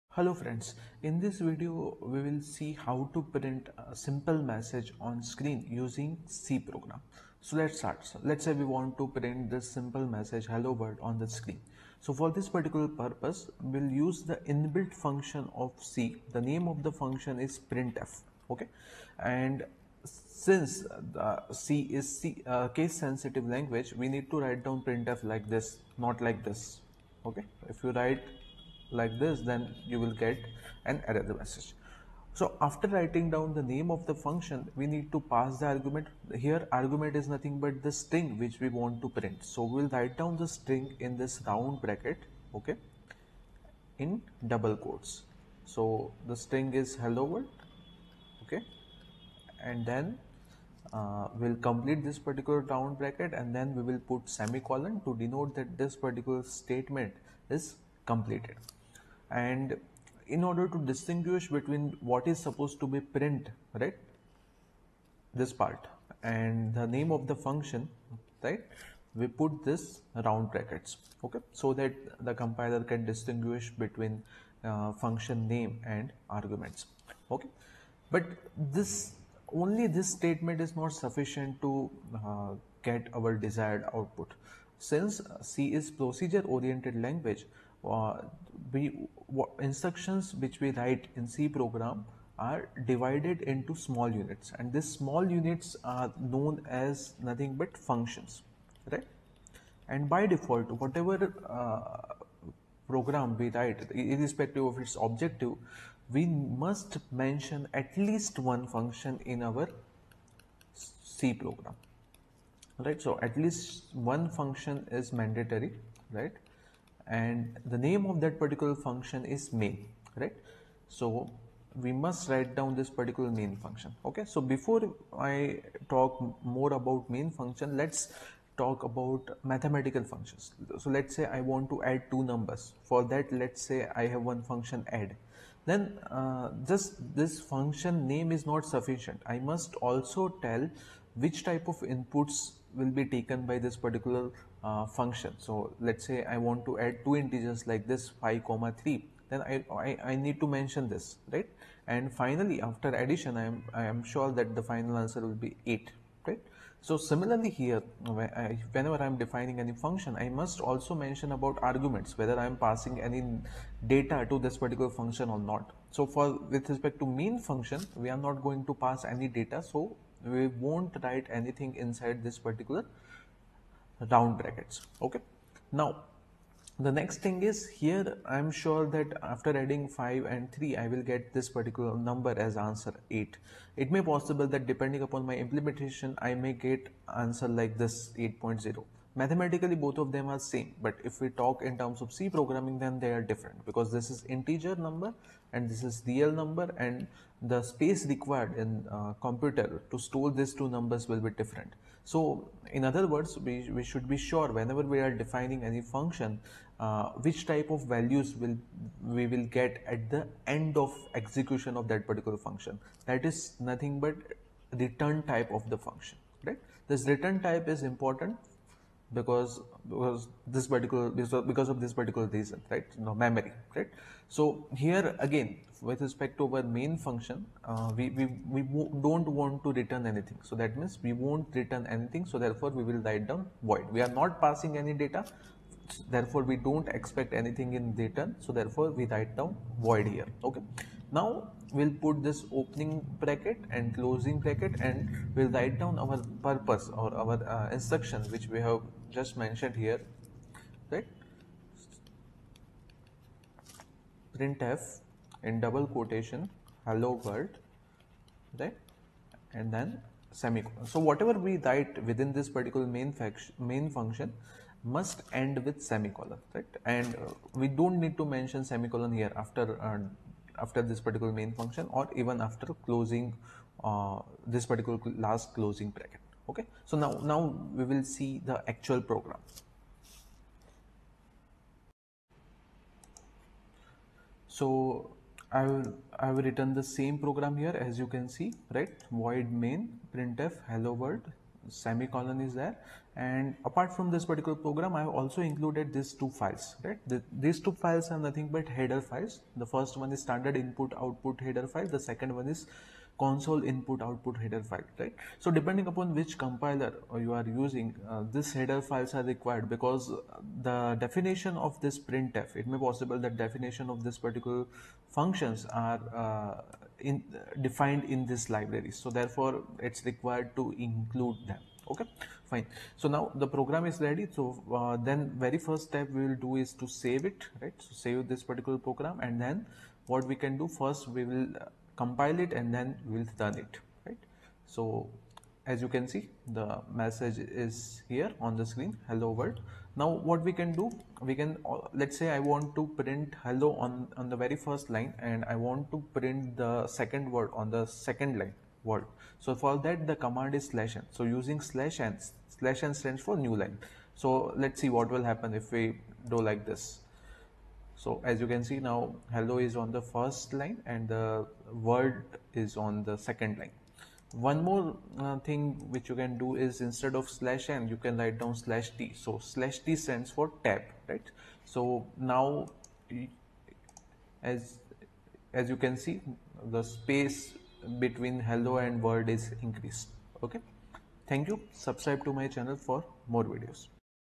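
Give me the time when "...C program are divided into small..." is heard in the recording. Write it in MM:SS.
01:31.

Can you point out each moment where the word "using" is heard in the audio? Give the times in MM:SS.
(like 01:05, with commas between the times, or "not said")
00:05, 05:07, 05:51.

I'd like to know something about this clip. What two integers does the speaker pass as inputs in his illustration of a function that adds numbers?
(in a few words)
5 and 3.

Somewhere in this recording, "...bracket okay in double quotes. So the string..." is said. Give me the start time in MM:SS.
00:41.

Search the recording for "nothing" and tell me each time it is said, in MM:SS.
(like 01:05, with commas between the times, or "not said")
00:37, 01:37, 03:33, 04:58.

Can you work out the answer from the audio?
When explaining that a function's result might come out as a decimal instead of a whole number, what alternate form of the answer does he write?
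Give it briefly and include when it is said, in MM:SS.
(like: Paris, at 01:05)
8.0, at 03:08.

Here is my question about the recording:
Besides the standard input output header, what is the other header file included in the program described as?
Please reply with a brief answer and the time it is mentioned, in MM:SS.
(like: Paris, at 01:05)
console input output, at 05:03.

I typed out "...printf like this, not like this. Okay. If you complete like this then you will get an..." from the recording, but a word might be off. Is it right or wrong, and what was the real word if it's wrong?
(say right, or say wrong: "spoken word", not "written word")
wrong: "write", not "complete".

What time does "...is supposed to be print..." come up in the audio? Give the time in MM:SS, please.
01:02.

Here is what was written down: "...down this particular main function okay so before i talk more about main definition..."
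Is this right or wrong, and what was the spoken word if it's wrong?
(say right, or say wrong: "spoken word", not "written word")
wrong: "function", not "definition".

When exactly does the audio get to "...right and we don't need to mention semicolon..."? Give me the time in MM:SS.
04:26.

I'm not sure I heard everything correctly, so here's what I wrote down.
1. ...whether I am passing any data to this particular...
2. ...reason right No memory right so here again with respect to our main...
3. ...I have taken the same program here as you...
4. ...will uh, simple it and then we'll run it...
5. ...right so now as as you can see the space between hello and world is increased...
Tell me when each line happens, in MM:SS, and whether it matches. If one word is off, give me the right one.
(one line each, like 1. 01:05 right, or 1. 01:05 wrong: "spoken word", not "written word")
1. 02:42 right
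2. 03:42 right
3. 04:46 wrong: "written", not "taken"
4. 05:31 wrong: "compile", not "simple"
5. 06:11 right.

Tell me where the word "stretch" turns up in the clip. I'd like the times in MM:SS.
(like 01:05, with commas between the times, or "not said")
not said.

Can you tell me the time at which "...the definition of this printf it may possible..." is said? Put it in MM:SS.
05:10.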